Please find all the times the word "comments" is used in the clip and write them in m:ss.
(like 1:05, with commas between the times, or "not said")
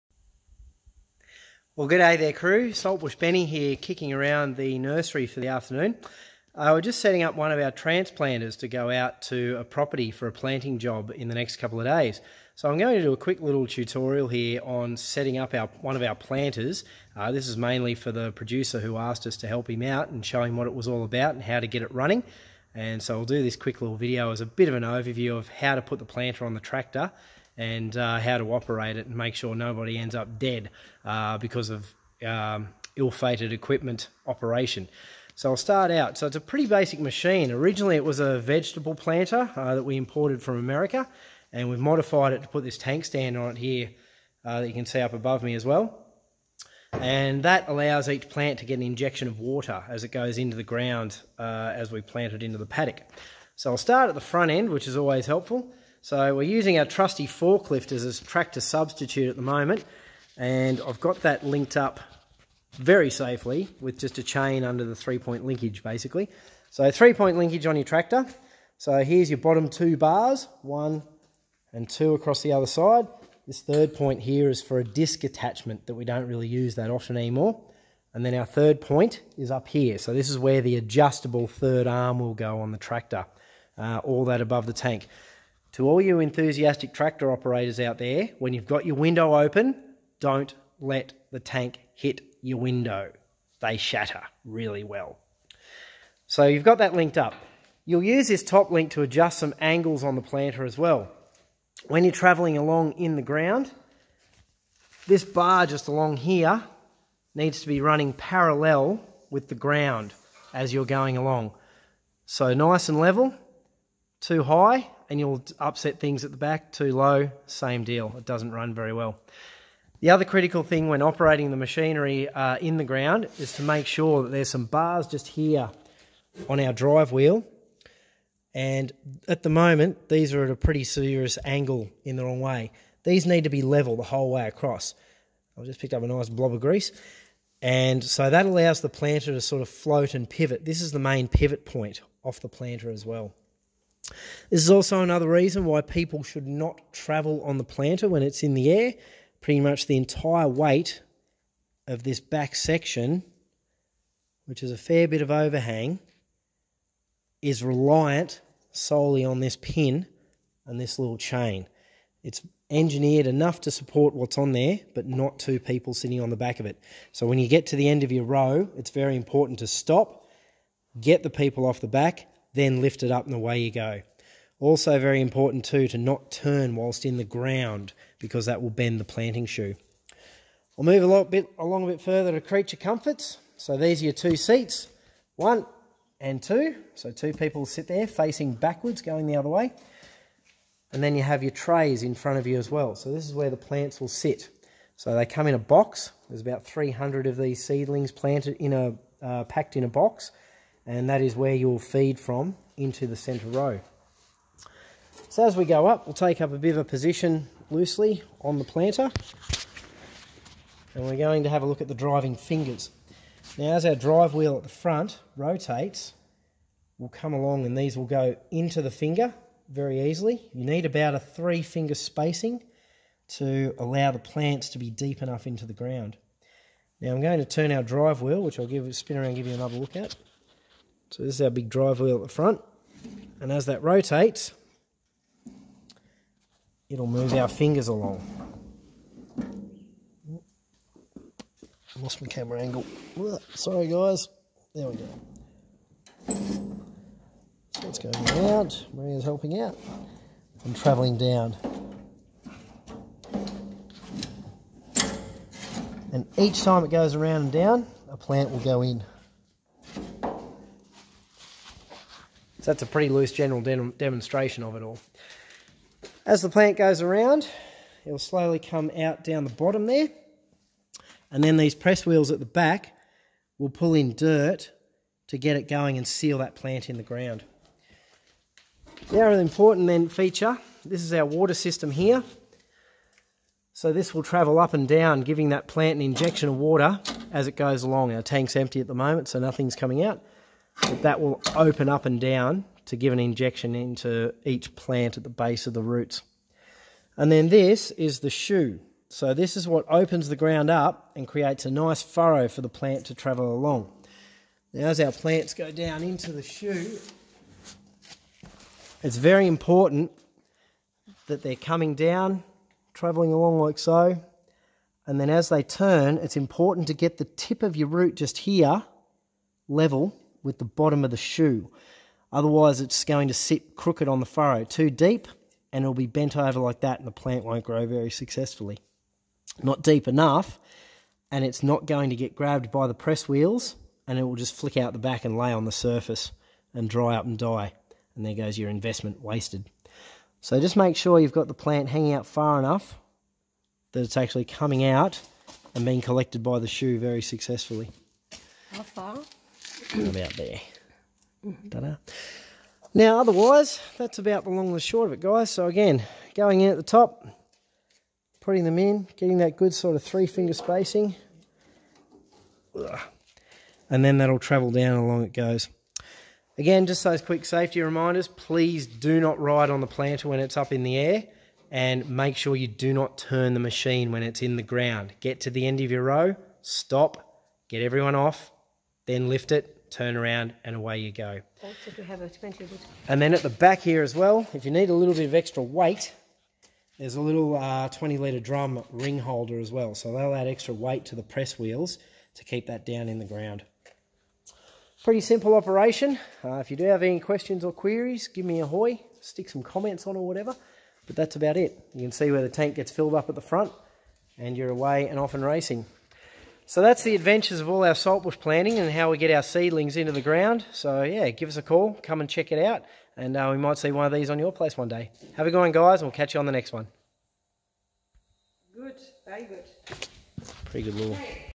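6:39.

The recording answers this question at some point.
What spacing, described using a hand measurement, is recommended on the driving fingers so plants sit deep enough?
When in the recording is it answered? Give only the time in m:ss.
3:41.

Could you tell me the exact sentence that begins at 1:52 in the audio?
So nice and level, too high, and you'll upset things at the back.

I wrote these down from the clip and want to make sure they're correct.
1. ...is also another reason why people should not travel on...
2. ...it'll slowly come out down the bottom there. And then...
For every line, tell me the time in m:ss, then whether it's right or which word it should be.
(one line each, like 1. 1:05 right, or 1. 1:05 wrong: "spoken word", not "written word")
1. 2:24 right
2. 4:28 right.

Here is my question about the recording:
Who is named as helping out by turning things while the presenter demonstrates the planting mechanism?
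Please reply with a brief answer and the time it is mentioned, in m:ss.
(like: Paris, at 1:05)
Maria, at 4:08.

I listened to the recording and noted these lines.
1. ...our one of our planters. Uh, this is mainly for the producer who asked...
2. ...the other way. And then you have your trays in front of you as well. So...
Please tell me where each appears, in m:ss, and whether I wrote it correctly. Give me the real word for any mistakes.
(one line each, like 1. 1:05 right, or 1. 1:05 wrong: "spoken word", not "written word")
1. 0:15 right
2. 3:09 right.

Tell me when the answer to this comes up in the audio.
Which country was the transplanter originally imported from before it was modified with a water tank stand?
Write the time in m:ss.
0:40.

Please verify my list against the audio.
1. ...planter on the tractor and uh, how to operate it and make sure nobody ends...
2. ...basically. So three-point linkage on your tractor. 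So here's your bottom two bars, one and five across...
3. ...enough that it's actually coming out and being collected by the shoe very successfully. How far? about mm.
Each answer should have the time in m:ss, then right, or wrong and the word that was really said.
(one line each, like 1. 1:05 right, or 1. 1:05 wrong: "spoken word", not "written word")
1. 0:26 right
2. 1:05 wrong: "two", not "five"
3. 5:42 right.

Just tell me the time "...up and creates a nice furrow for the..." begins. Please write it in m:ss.
5:00.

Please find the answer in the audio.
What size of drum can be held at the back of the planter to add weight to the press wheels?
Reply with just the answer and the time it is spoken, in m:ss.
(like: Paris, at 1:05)
20 litre, at 6:27.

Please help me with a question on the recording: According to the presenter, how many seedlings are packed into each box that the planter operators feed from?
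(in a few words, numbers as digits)
300.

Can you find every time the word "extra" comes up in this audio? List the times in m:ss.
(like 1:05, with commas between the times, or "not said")
6:25, 6:30.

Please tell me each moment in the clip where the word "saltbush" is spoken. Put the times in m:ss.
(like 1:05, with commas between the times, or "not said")
0:02, 6:47.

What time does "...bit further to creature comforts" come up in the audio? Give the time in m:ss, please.
3:01.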